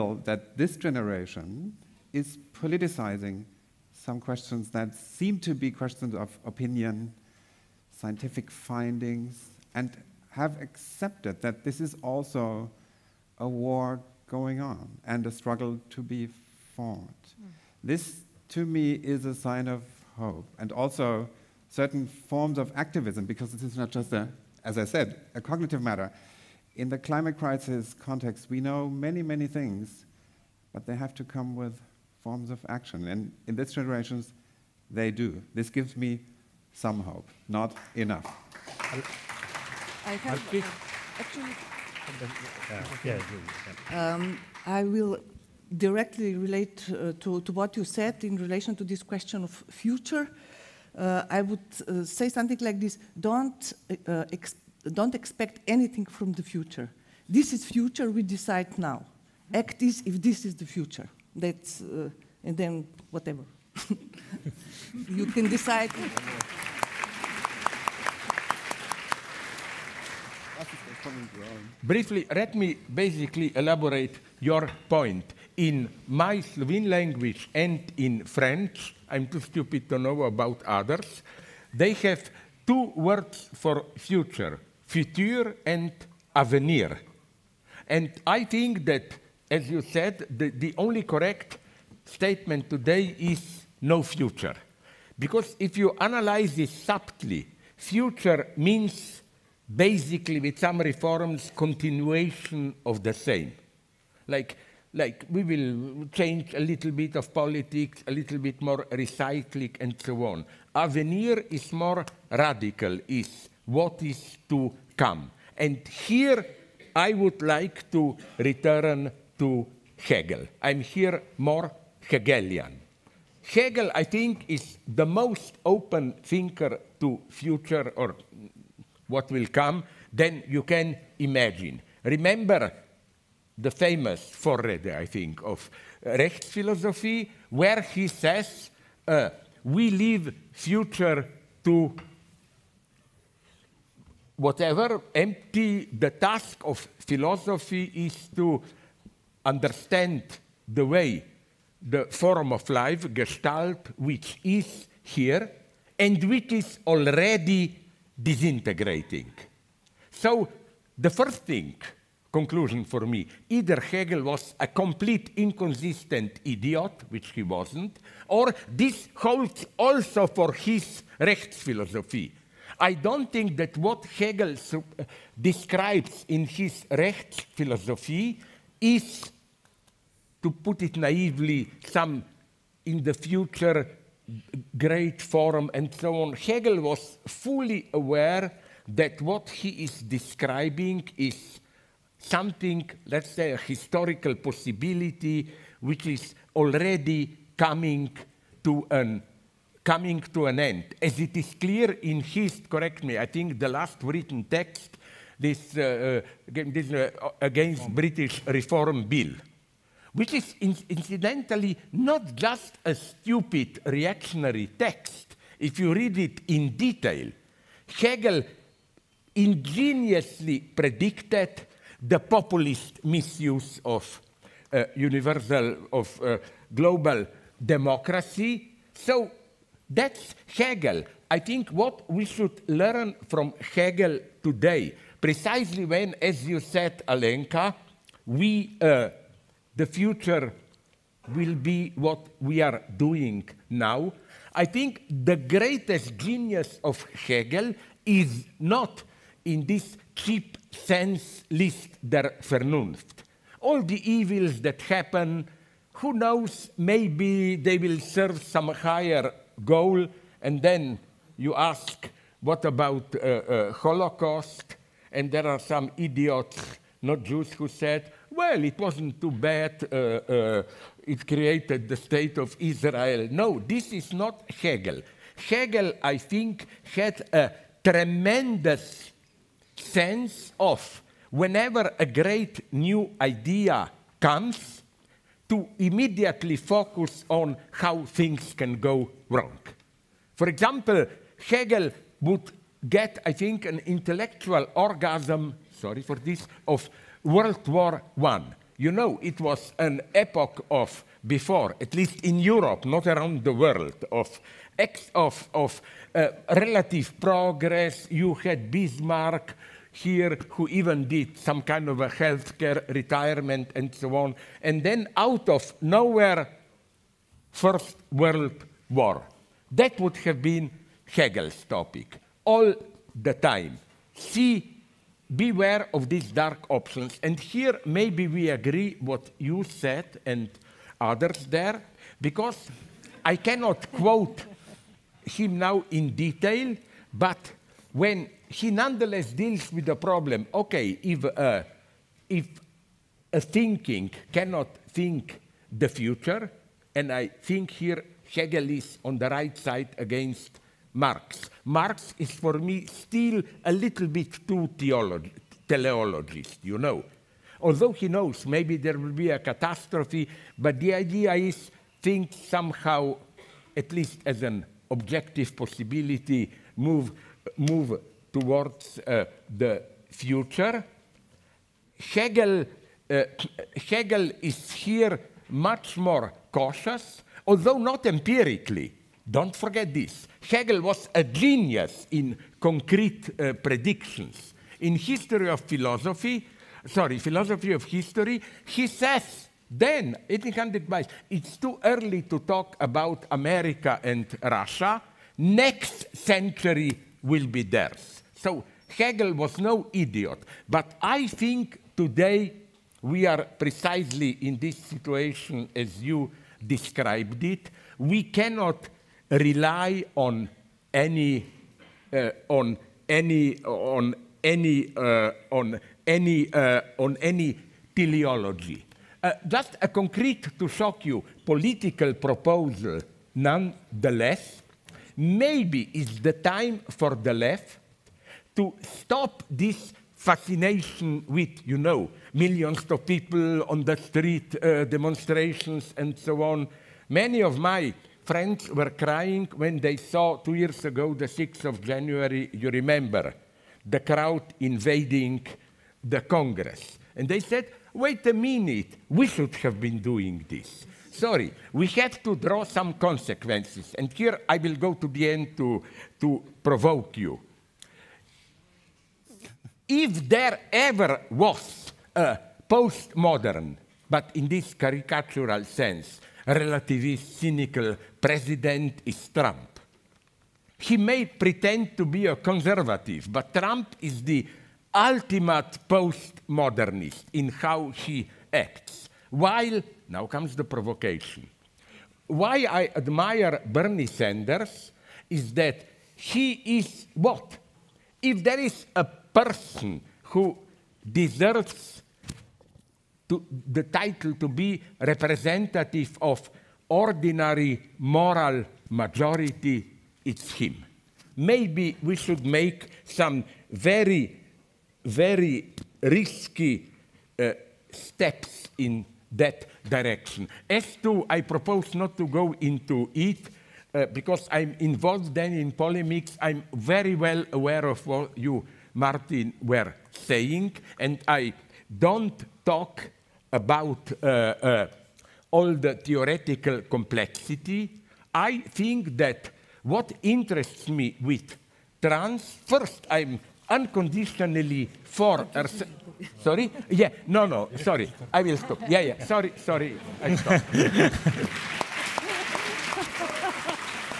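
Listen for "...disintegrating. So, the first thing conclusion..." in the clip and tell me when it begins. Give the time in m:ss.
2:38.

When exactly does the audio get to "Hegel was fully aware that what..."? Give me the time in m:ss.
3:06.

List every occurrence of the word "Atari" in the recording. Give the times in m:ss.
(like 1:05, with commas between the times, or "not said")
not said.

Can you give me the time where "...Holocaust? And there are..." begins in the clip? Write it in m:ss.
4:23.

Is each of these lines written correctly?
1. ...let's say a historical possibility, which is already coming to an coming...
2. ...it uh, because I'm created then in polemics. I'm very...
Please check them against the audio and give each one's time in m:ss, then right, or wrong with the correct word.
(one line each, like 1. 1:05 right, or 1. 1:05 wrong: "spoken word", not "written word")
1. 3:13 right
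2. 8:33 wrong: "involved", not "created".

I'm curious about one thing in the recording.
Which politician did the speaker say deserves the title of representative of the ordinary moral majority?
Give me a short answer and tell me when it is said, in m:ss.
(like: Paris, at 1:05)
Bernie Sanders, at 8:03.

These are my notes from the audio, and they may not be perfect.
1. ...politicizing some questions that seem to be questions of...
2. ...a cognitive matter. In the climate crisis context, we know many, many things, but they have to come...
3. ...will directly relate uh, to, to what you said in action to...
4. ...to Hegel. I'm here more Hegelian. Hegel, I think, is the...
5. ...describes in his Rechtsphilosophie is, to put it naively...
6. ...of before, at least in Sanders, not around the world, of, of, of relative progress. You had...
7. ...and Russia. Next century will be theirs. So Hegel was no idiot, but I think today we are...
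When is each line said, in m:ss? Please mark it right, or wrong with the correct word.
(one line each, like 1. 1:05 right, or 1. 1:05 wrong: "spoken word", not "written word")
1. 0:02 right
2. 0:25 right
3. 0:44 wrong: "relation", not "action"
4. 1:59 right
5. 2:55 right
6. 5:00 wrong: "Europe", not "Sanders"
7. 6:34 right.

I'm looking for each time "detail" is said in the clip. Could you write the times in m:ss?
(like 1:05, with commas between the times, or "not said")
3:36, 5:36.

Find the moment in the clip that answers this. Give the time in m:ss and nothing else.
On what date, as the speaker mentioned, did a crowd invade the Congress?
7:21.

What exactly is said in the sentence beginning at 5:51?
Marx is for me still a little bit too theolo teleologist, you know.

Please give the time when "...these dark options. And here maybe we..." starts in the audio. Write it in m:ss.
5:26.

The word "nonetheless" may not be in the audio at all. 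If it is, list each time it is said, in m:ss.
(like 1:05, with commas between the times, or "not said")
5:38, 7:03.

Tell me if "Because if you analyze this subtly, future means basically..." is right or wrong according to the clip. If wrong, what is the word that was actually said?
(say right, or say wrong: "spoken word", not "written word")
right.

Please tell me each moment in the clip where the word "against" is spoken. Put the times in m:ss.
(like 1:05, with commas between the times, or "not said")
3:27, 5:49.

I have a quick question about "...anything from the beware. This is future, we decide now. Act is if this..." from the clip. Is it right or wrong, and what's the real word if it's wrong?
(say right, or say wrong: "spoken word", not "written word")
wrong: "future", not "beware".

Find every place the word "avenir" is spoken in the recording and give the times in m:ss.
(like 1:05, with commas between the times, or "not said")
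1:26, 1:50.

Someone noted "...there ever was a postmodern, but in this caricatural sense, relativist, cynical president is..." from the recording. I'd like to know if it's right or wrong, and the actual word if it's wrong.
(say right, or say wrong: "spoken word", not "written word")
right.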